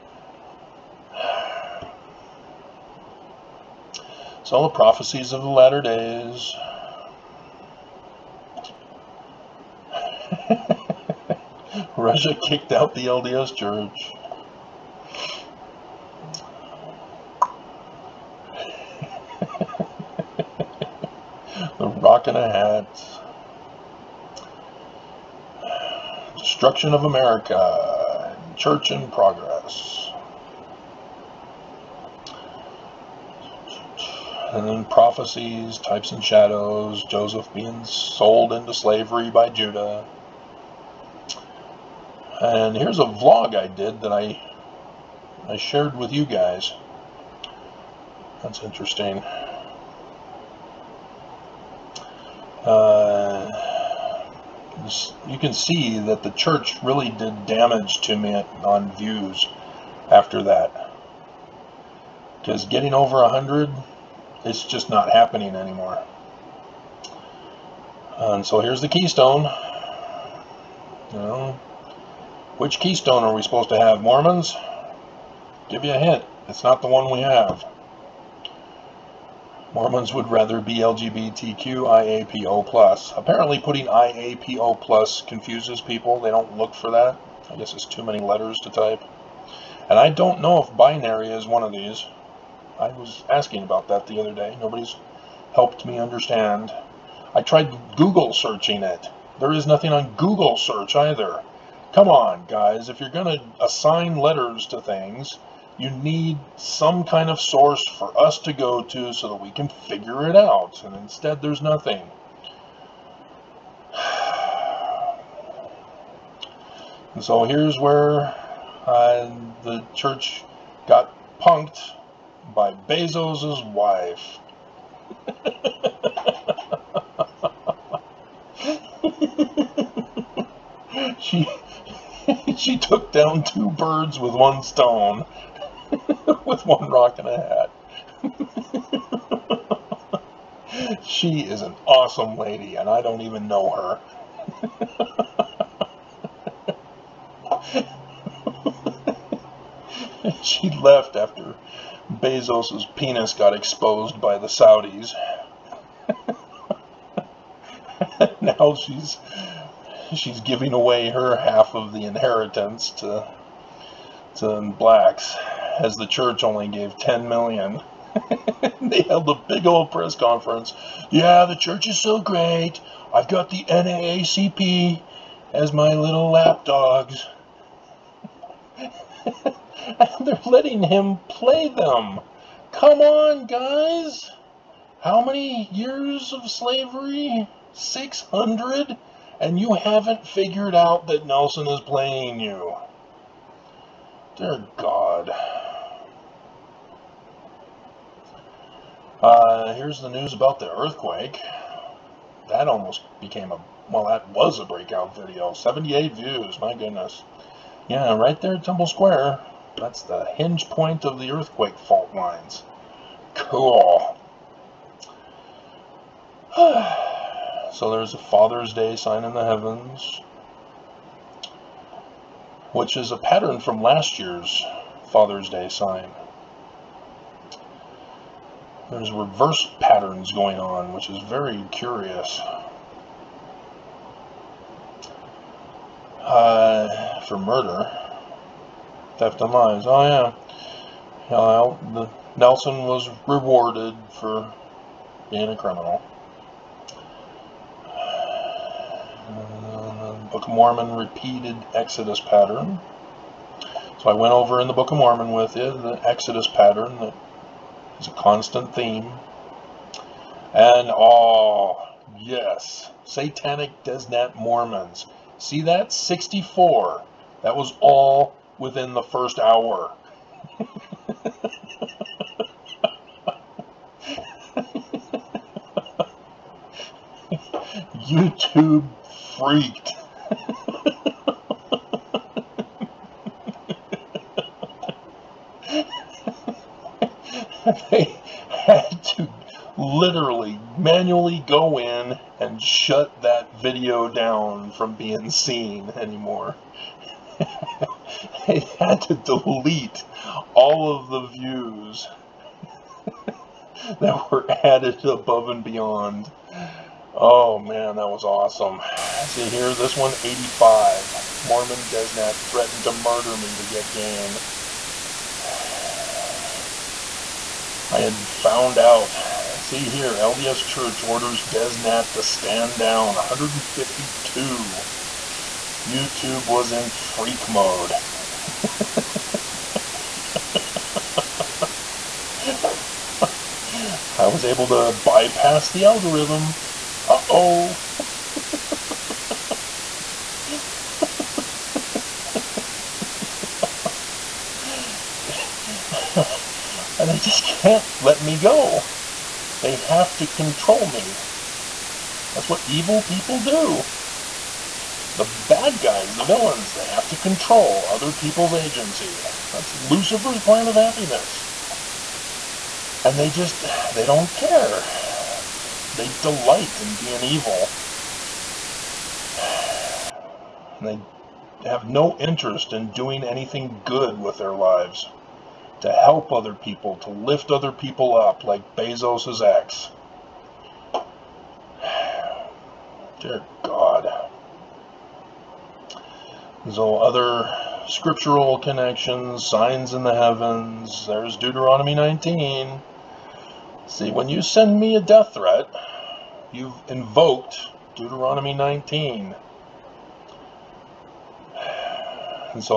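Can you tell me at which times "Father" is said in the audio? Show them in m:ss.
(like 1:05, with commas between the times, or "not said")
3:38, 3:45.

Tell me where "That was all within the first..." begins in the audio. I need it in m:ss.
4:27.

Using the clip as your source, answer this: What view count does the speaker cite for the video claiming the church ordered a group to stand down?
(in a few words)
152.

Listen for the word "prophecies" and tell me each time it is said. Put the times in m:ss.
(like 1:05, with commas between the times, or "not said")
0:04, 0:34.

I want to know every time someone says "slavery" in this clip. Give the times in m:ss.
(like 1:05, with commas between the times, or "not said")
0:38, 3:06.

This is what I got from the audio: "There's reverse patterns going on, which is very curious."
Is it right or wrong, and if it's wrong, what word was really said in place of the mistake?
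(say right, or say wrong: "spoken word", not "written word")
right.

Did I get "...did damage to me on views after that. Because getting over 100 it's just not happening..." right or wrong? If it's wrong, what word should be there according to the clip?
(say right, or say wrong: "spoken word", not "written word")
right.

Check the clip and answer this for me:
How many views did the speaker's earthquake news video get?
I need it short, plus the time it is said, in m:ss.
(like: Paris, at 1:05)
78, at 3:25.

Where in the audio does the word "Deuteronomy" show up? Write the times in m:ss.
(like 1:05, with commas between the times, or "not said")
6:31, 6:37.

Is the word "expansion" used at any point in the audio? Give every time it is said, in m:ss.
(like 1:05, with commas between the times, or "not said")
not said.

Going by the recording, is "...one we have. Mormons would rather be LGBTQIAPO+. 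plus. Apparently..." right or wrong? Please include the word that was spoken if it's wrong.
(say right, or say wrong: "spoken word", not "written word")
right.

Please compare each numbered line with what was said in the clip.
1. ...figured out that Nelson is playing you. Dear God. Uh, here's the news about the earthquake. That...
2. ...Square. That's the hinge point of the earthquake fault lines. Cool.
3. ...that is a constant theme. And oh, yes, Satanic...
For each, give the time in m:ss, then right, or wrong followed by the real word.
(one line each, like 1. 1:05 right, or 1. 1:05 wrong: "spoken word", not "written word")
1. 3:10 right
2. 3:28 right
3. 4:16 right.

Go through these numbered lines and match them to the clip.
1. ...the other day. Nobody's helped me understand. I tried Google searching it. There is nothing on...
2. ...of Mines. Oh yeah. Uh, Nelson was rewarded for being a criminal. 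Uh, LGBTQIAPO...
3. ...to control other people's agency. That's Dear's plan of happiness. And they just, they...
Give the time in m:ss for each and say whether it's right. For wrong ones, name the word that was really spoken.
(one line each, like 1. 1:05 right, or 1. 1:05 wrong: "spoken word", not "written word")
1. 1:34 right
2. 3:59 wrong: "Book", not "LGBTQIAPO"
3. 5:57 wrong: "Lucifer", not "Dear".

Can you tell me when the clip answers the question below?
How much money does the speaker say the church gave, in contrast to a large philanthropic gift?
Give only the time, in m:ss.
2:46.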